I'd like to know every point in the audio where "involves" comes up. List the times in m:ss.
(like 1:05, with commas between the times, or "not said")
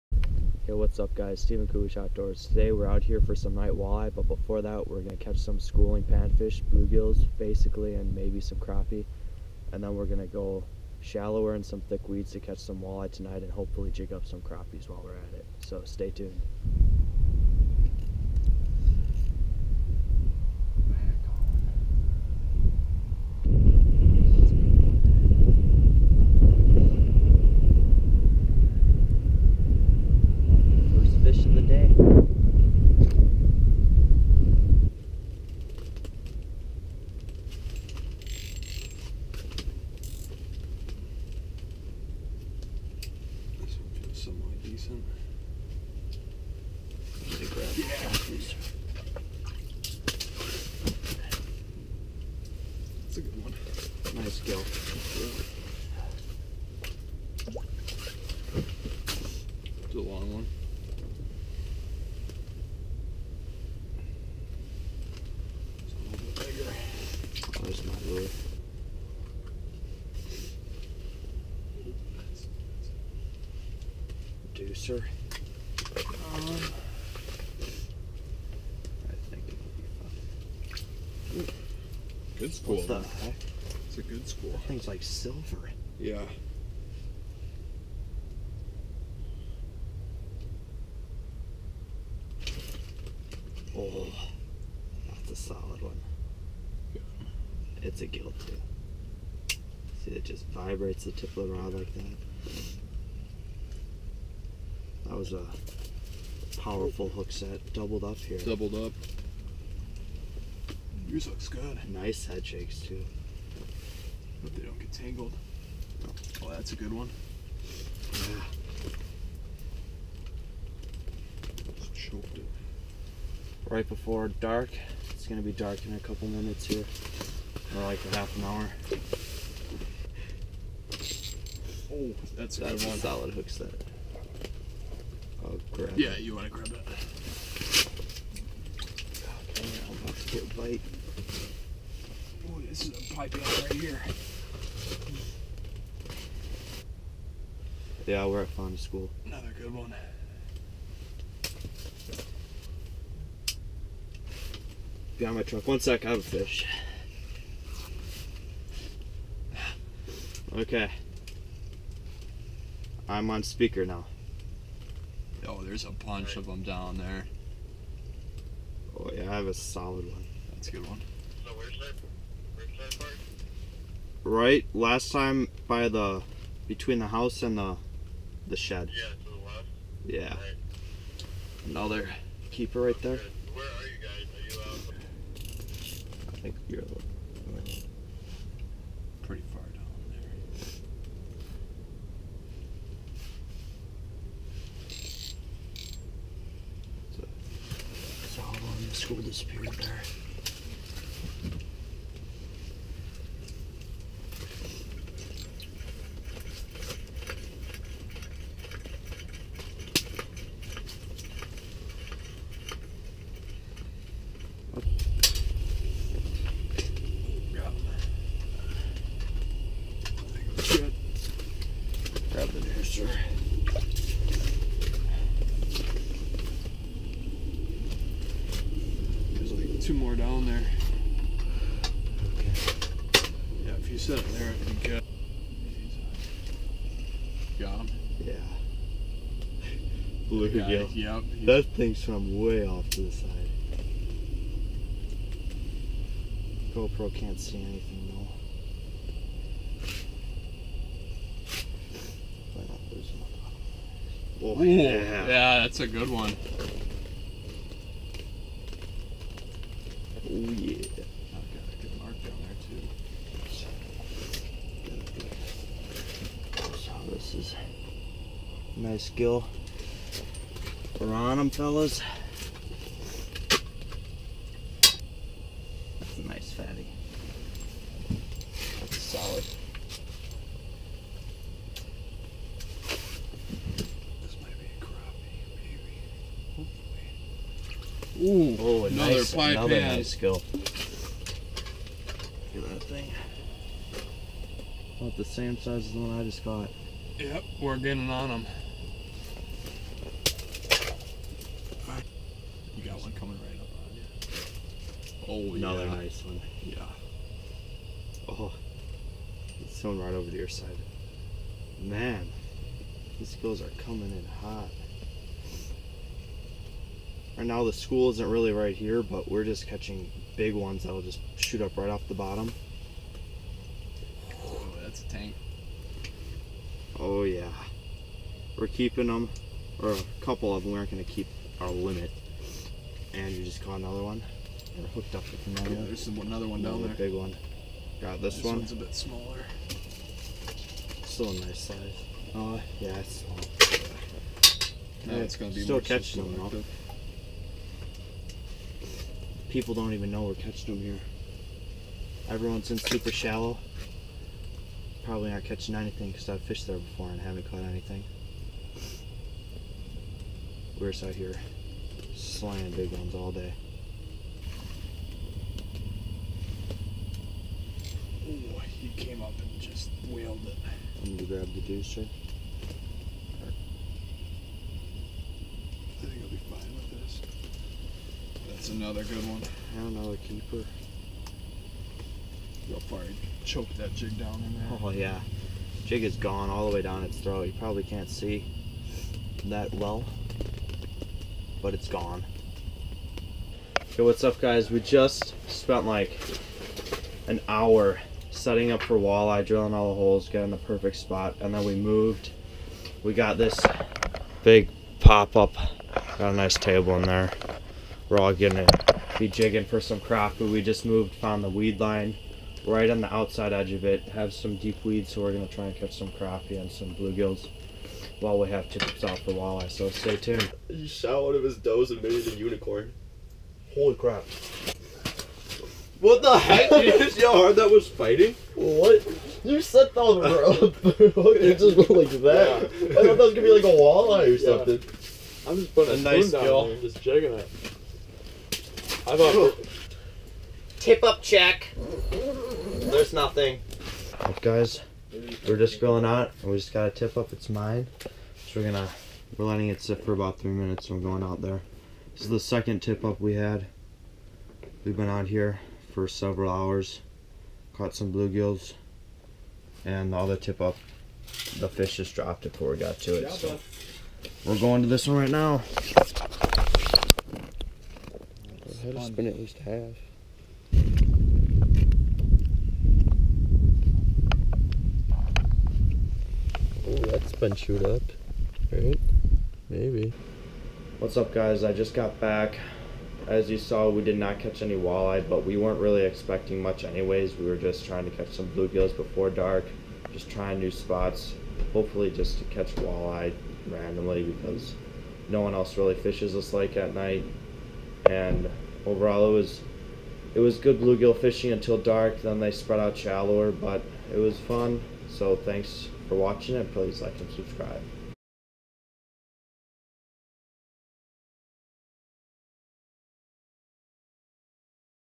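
not said.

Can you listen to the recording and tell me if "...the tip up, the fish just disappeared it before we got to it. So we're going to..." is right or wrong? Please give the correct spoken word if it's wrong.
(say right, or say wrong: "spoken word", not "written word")
wrong: "dropped", not "disappeared".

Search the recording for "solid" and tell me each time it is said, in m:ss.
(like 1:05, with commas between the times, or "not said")
1:35, 2:12, 2:49, 4:38.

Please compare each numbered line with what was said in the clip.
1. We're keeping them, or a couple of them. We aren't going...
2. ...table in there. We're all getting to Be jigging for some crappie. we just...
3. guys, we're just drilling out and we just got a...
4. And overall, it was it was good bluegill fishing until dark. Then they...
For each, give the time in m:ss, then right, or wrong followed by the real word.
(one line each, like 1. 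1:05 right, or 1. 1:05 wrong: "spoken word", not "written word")
1. 5:28 right
2. 6:46 right
3. 7:24 wrong: "grilling", not "drilling"
4. 8:18 right.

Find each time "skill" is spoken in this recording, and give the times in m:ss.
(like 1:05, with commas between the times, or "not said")
4:29, 4:50.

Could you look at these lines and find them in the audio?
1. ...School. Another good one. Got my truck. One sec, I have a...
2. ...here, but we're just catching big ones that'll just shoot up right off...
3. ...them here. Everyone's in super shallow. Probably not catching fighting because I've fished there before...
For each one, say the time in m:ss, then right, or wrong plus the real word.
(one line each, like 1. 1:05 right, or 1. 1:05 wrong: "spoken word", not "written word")
1. 2:28 right
2. 5:18 right
3. 5:50 wrong: "anything", not "fighting".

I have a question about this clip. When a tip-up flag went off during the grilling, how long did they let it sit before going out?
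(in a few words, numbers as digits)
3 minutes.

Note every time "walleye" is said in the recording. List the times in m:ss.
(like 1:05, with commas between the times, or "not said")
0:03, 0:12, 6:38, 6:59, 7:13, 8:04, 8:12.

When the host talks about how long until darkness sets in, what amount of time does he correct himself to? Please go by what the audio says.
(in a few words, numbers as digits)
half an hour.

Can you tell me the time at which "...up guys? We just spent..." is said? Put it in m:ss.
6:34.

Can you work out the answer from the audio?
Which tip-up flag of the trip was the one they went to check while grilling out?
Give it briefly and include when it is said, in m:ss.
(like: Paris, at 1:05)
the second, at 7:32.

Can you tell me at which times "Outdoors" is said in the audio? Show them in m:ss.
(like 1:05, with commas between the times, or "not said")
0:01.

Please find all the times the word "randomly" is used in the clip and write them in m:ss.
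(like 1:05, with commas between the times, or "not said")
8:13.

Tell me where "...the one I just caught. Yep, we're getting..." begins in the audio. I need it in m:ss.
4:55.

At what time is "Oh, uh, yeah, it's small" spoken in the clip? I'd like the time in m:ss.
5:42.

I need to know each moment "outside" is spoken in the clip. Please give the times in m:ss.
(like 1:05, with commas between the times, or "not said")
6:53.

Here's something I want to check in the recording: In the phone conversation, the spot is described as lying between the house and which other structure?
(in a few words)
the shed.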